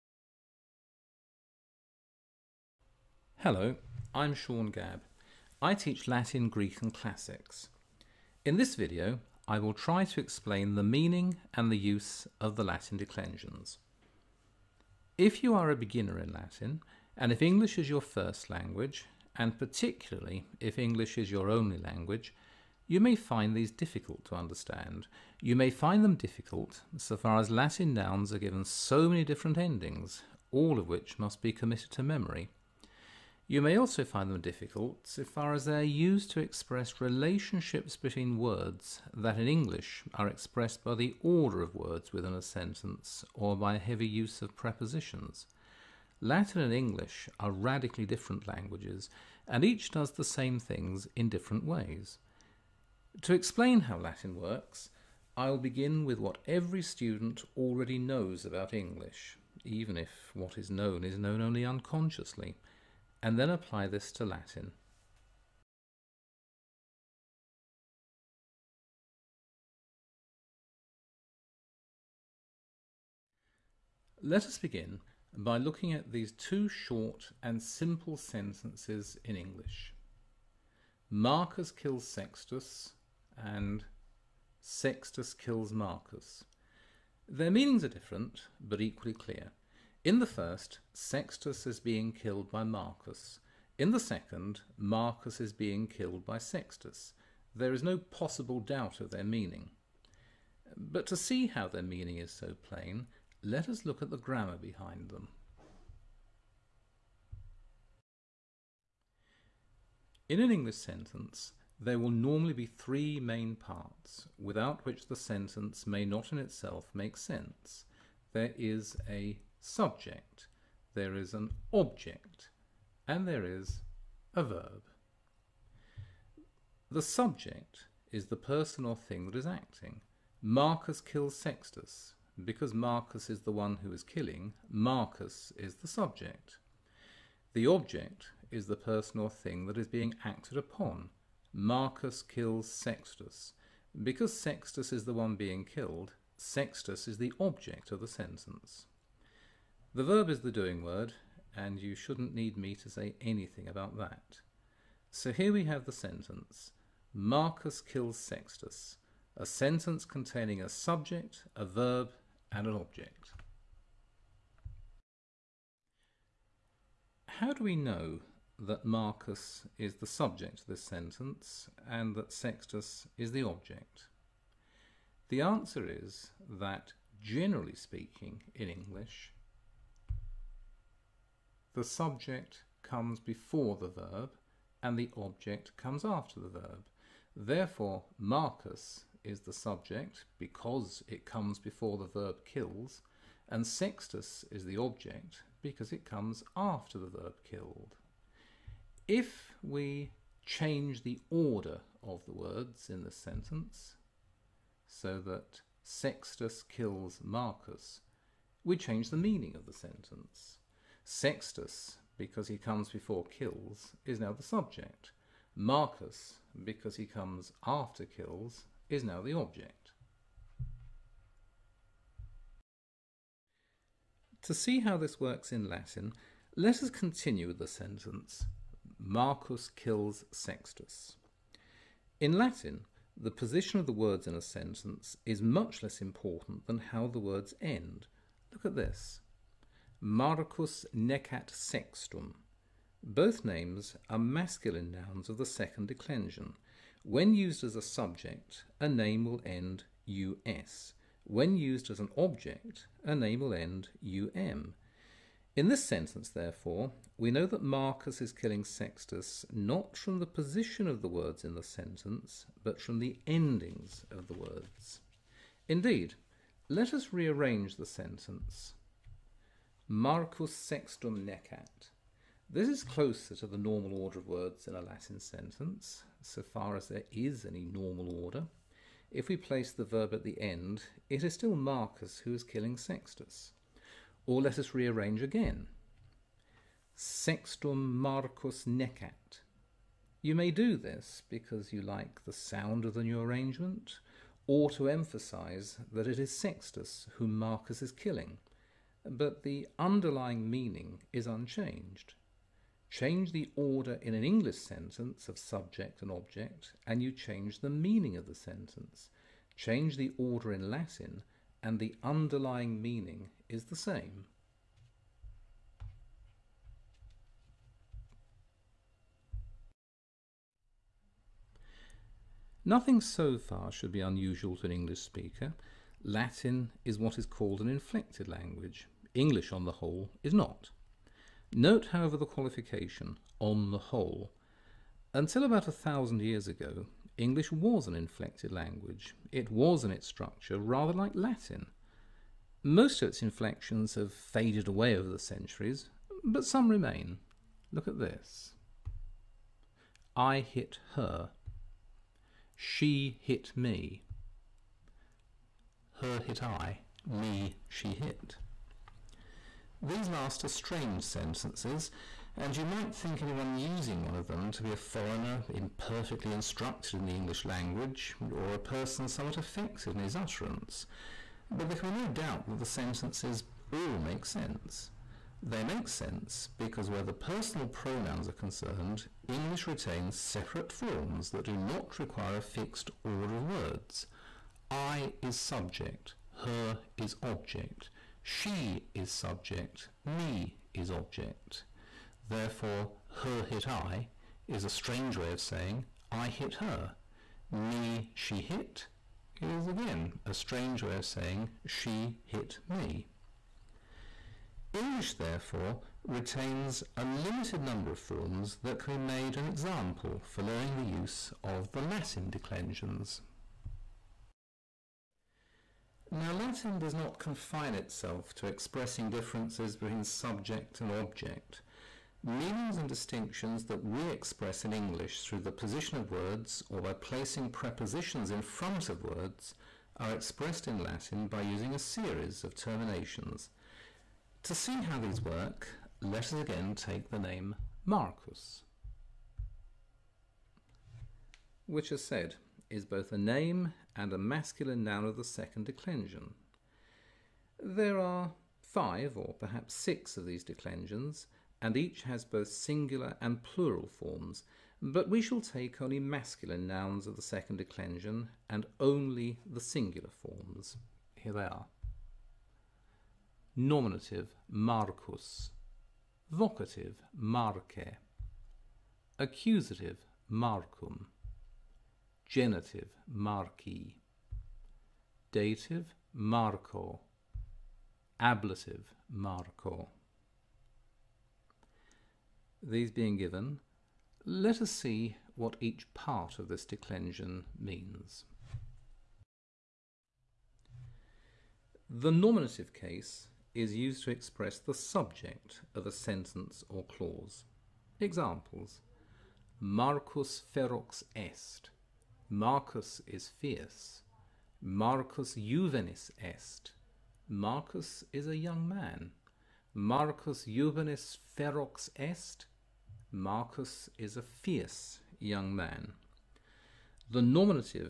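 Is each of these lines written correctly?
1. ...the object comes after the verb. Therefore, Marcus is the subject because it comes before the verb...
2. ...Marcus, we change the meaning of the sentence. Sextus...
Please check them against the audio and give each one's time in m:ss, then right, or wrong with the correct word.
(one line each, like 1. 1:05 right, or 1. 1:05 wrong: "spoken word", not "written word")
1. 3:04 right
2. 3:27 right.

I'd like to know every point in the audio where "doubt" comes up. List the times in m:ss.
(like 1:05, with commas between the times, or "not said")
1:38, 6:12.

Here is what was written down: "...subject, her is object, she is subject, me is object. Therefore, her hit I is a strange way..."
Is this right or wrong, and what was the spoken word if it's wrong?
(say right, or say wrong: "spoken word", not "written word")
right.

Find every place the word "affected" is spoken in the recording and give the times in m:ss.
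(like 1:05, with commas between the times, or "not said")
6:09.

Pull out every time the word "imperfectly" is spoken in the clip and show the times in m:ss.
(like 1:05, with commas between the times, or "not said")
6:05.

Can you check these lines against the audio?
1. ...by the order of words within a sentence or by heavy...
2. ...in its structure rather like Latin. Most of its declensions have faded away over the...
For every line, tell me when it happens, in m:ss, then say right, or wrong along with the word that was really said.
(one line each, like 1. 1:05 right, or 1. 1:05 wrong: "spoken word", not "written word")
1. 0:40 right
2. 5:39 wrong: "inflections", not "declensions".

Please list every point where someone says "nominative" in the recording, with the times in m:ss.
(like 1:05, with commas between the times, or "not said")
7:43, 8:12, 8:37.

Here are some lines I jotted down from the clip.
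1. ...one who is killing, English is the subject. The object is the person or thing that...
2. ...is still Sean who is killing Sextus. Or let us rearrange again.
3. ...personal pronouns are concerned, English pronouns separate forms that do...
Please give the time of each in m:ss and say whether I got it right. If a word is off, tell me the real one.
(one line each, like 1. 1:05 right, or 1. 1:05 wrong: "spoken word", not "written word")
1. 2:13 wrong: "Marcus", not "English"
2. 4:41 wrong: "Marcus", not "Sean"
3. 6:17 wrong: "retains", not "pronouns".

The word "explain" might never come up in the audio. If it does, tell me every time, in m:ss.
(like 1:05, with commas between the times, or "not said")
0:10, 0:53.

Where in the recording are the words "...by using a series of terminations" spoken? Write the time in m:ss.
7:11.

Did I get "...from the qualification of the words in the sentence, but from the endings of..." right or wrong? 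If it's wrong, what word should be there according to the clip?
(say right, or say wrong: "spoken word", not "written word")
wrong: "position", not "qualification".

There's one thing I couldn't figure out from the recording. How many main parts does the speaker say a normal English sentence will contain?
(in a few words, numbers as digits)
3.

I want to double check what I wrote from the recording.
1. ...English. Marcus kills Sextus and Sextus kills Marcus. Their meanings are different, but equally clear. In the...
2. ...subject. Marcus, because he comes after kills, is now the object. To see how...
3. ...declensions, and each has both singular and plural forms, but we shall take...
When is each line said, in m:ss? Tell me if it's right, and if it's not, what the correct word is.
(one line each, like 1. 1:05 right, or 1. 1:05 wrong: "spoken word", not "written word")
1. 1:19 right
2. 3:34 right
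3. 7:30 right.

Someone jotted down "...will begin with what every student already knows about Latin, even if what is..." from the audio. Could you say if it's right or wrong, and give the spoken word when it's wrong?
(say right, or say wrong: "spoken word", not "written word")
wrong: "English", not "Latin".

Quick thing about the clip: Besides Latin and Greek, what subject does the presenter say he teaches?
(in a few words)
Classics.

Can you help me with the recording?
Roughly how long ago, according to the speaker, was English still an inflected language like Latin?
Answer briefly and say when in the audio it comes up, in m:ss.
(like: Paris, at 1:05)
a thousand years, at 5:35.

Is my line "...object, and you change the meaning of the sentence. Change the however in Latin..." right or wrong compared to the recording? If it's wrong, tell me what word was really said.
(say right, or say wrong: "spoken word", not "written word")
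wrong: "order", not "however".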